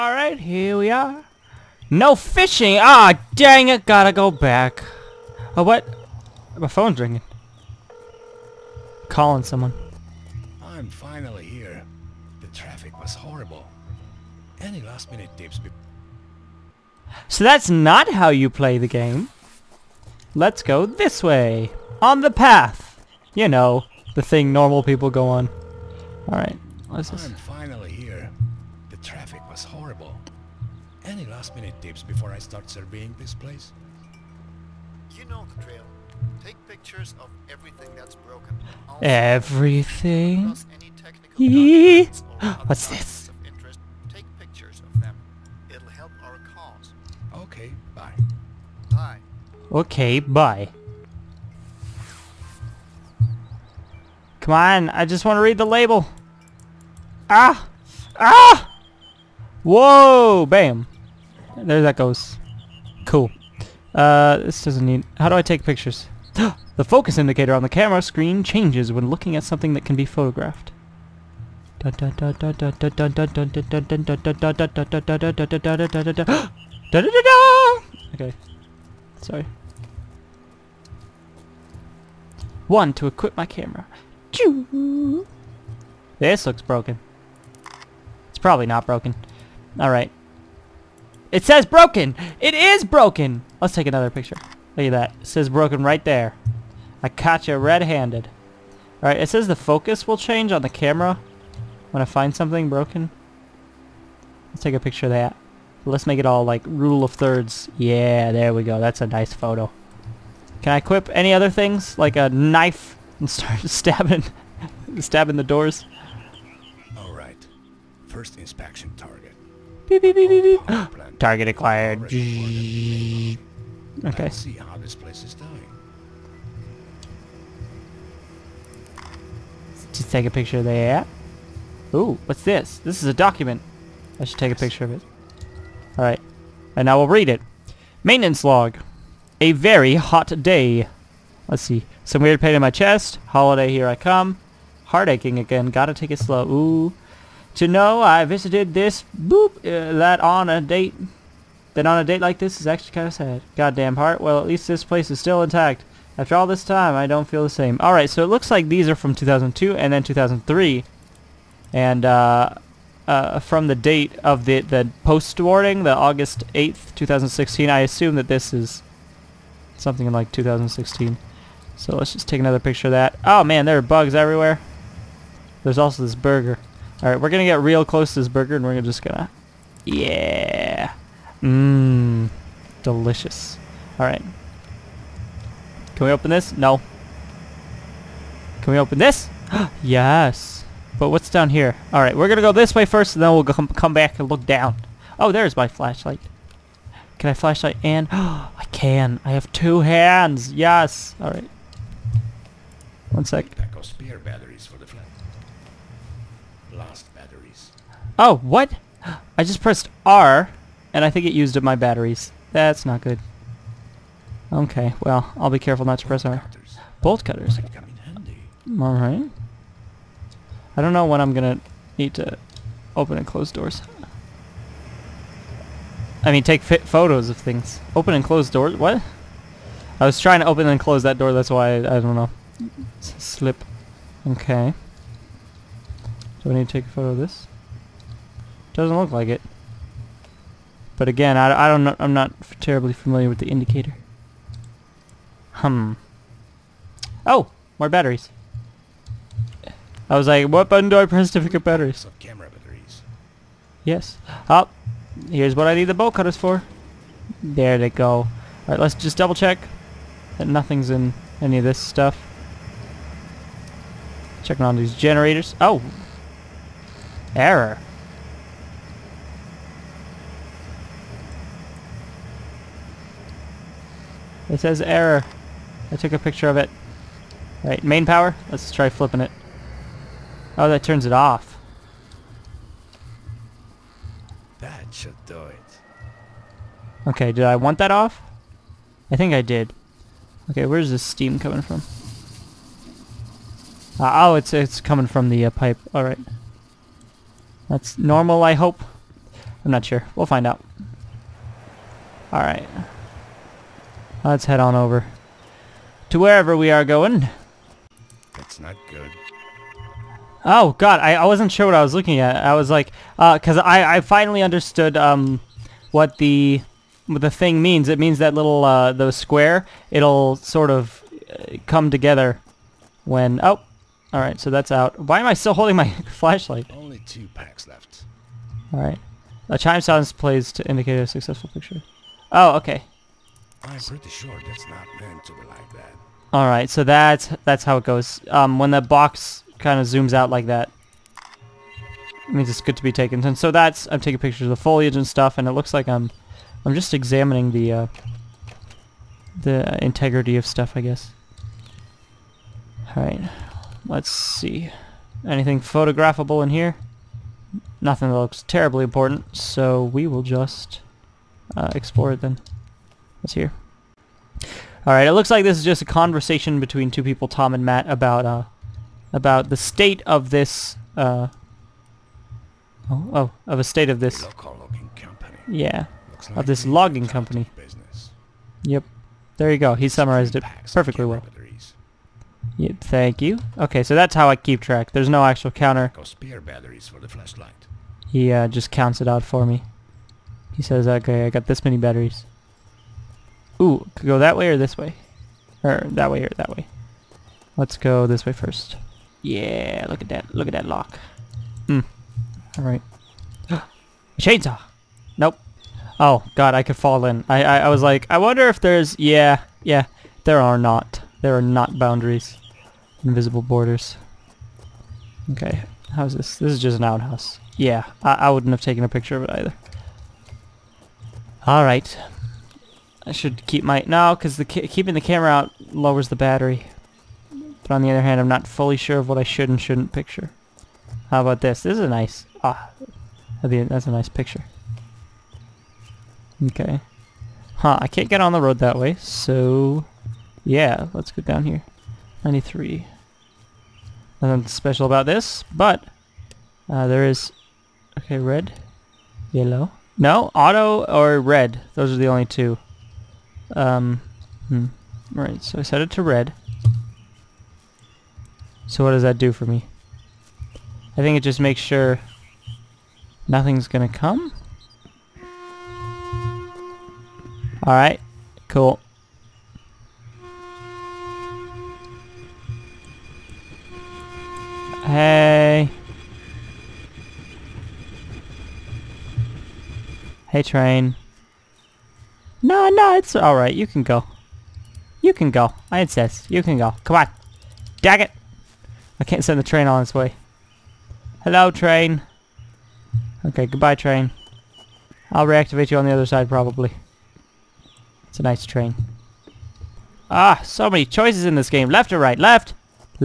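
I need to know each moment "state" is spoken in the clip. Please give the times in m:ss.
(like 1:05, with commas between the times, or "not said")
6:09, 6:13.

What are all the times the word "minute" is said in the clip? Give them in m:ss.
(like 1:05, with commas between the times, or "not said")
0:15, 0:31.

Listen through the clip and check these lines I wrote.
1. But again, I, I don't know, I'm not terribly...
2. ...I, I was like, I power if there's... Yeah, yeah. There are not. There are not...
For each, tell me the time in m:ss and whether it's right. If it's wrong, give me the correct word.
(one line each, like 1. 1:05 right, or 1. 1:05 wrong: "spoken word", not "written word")
1. 4:00 right
2. 6:47 wrong: "wonder", not "power".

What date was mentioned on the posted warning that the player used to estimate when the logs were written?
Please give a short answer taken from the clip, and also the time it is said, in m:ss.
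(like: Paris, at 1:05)
August 8th, 2016, at 2:45.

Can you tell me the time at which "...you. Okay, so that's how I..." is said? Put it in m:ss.
6:23.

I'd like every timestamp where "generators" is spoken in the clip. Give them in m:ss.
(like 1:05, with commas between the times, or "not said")
4:24.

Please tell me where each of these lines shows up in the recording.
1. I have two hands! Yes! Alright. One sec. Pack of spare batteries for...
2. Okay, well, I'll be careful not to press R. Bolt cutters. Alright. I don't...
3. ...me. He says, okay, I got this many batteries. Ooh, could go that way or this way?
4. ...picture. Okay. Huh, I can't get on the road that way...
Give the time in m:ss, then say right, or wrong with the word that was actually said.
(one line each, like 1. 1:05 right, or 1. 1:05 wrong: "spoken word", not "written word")
1. 3:19 right
2. 3:34 right
3. 6:29 right
4. 7:14 right.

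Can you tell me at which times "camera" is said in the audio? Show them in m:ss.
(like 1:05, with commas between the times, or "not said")
1:07, 1:23, 1:40, 4:12, 7:05.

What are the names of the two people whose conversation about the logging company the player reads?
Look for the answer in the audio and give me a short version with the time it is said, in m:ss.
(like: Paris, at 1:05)
Tom and Matt, at 6:07.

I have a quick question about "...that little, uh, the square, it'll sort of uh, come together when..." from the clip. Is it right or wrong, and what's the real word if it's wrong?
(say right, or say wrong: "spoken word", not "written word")
right.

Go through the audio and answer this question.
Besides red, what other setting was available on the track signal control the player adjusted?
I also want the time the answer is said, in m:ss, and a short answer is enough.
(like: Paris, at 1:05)
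Auto, at 7:30.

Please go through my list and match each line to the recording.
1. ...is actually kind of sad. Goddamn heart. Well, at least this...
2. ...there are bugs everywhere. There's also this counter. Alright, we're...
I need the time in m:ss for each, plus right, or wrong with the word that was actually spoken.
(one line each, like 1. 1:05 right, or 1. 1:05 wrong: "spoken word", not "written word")
1. 2:32 right
2. 2:53 wrong: "burger", not "counter".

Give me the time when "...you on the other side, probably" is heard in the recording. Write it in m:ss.
8:15.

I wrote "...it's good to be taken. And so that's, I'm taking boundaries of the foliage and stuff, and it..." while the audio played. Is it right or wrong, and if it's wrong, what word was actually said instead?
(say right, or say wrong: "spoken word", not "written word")
wrong: "pictures", not "boundaries".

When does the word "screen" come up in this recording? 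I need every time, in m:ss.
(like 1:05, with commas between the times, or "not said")
1:08.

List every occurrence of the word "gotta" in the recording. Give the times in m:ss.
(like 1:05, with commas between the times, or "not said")
0:03, 2:25.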